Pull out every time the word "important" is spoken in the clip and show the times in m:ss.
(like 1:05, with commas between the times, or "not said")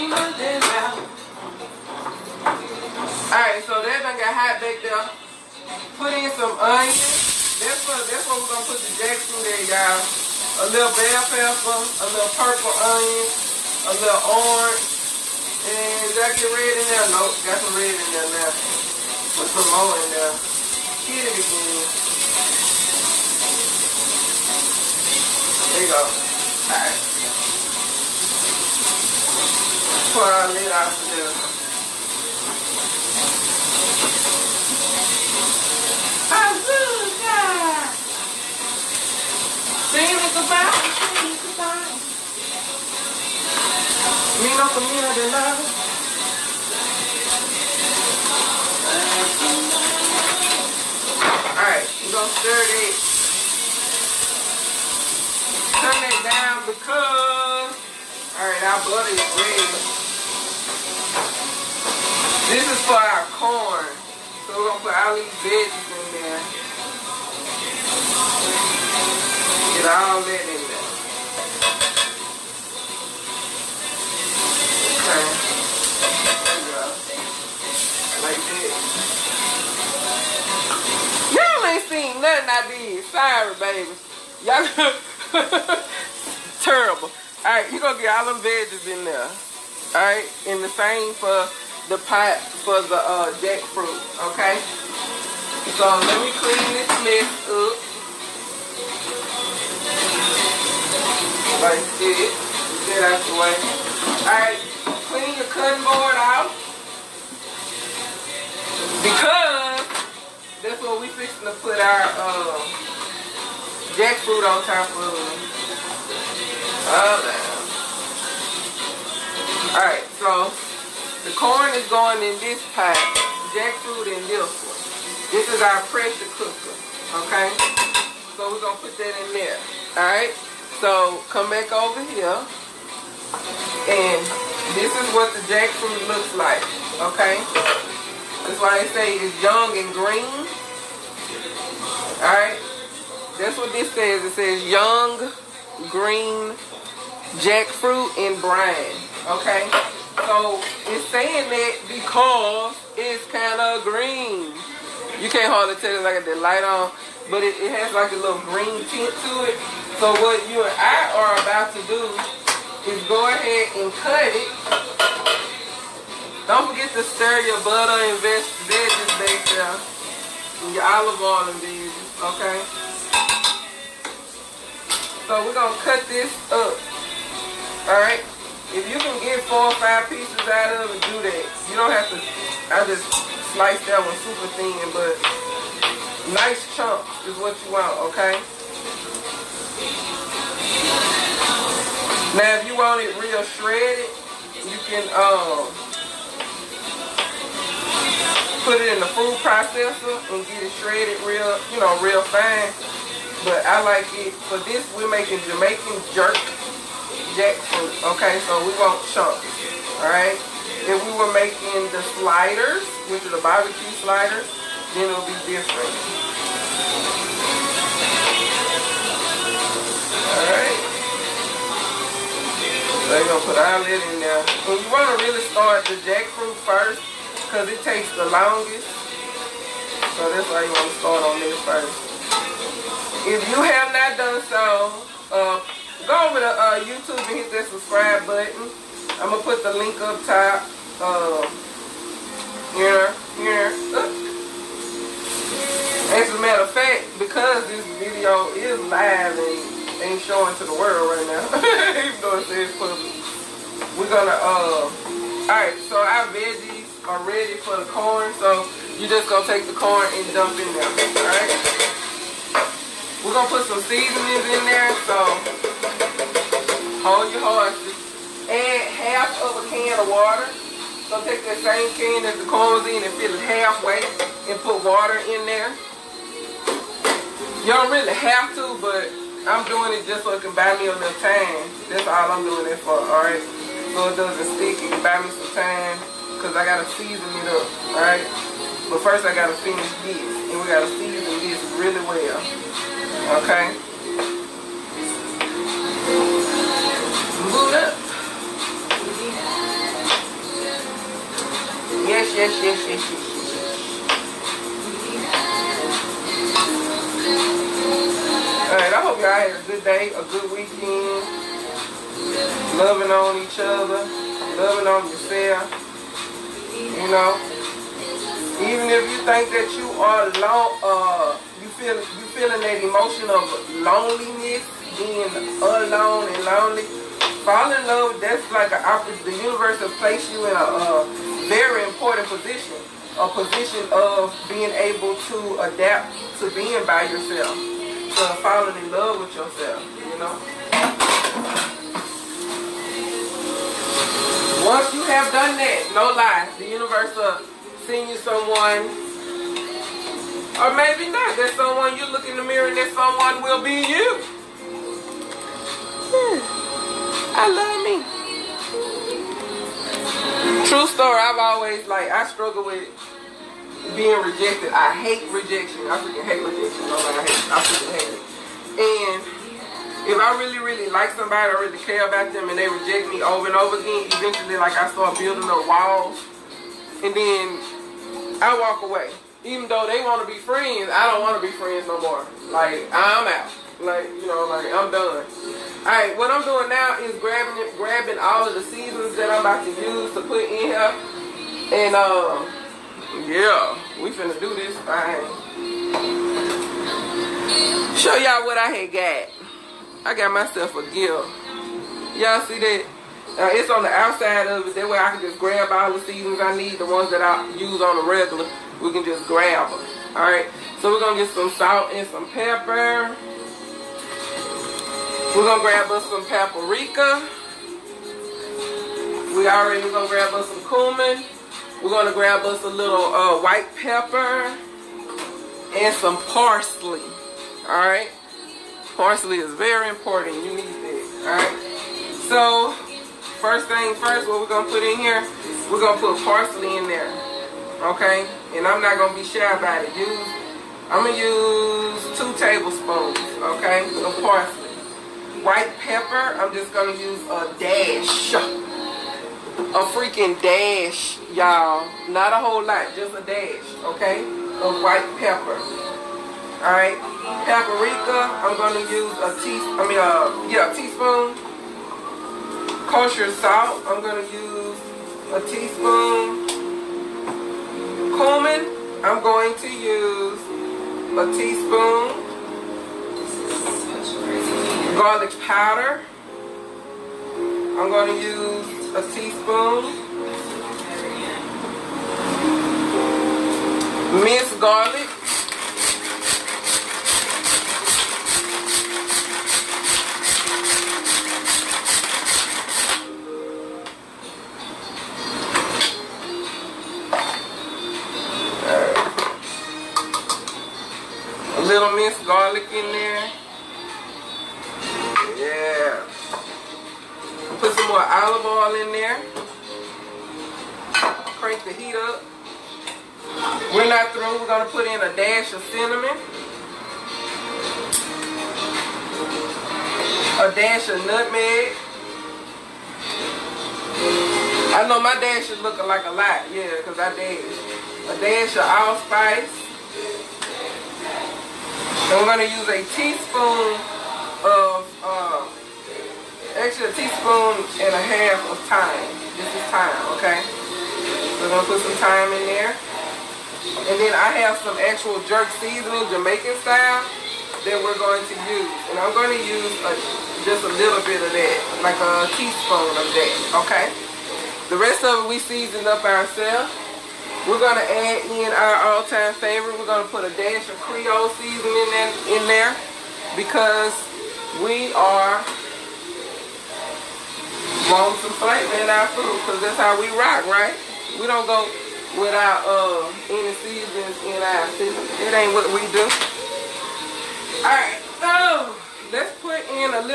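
5:31, 7:09.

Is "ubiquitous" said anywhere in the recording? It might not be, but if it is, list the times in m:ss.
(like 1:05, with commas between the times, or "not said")
not said.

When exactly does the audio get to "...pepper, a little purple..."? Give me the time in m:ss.
0:11.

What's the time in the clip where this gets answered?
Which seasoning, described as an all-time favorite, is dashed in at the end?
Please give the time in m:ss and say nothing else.
9:20.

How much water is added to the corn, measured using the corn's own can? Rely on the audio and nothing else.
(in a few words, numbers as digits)
half of a can.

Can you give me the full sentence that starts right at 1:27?
Alright, you gonna get all them veggies in there.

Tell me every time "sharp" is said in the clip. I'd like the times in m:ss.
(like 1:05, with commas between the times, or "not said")
not said.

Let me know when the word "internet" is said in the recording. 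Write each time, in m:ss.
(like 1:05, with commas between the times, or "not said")
not said.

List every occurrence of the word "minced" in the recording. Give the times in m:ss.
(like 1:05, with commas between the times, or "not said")
8:04, 8:21.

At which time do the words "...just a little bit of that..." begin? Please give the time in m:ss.
9:10.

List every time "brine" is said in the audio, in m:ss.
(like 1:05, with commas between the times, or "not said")
2:28.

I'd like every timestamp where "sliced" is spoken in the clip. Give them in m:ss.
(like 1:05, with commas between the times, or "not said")
3:03.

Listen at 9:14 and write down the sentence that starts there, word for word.
The rest of it we seasoned up ourselves.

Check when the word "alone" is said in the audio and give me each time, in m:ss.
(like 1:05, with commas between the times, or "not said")
5:20, 5:25.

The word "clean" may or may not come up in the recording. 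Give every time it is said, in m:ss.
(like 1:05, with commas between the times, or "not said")
1:36, 1:45.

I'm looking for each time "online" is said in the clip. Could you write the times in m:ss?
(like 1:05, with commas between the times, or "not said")
not said.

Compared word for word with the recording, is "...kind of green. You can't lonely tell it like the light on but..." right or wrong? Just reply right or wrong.
wrong.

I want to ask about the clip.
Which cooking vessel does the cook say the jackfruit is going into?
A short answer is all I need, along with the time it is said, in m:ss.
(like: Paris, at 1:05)
pressure cooker, at 2:05.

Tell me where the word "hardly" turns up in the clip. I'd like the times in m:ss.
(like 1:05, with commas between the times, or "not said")
2:35.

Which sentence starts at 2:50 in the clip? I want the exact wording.
And your olive oil and veggies, okay?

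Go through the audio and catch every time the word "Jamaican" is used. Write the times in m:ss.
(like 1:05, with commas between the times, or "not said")
3:25, 9:06.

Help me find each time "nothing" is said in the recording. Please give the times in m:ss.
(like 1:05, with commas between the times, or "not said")
1:22.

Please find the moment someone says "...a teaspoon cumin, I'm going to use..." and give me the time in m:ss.
7:45.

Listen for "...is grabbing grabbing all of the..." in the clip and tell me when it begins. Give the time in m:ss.
6:27.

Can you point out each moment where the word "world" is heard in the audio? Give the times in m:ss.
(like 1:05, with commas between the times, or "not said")
4:10.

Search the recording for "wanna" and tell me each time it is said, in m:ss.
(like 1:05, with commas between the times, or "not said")
3:44, 3:50.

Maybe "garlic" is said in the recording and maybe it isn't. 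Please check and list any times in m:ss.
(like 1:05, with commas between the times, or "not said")
7:54, 8:04, 8:22.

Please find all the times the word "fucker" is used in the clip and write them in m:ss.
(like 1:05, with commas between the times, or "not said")
not said.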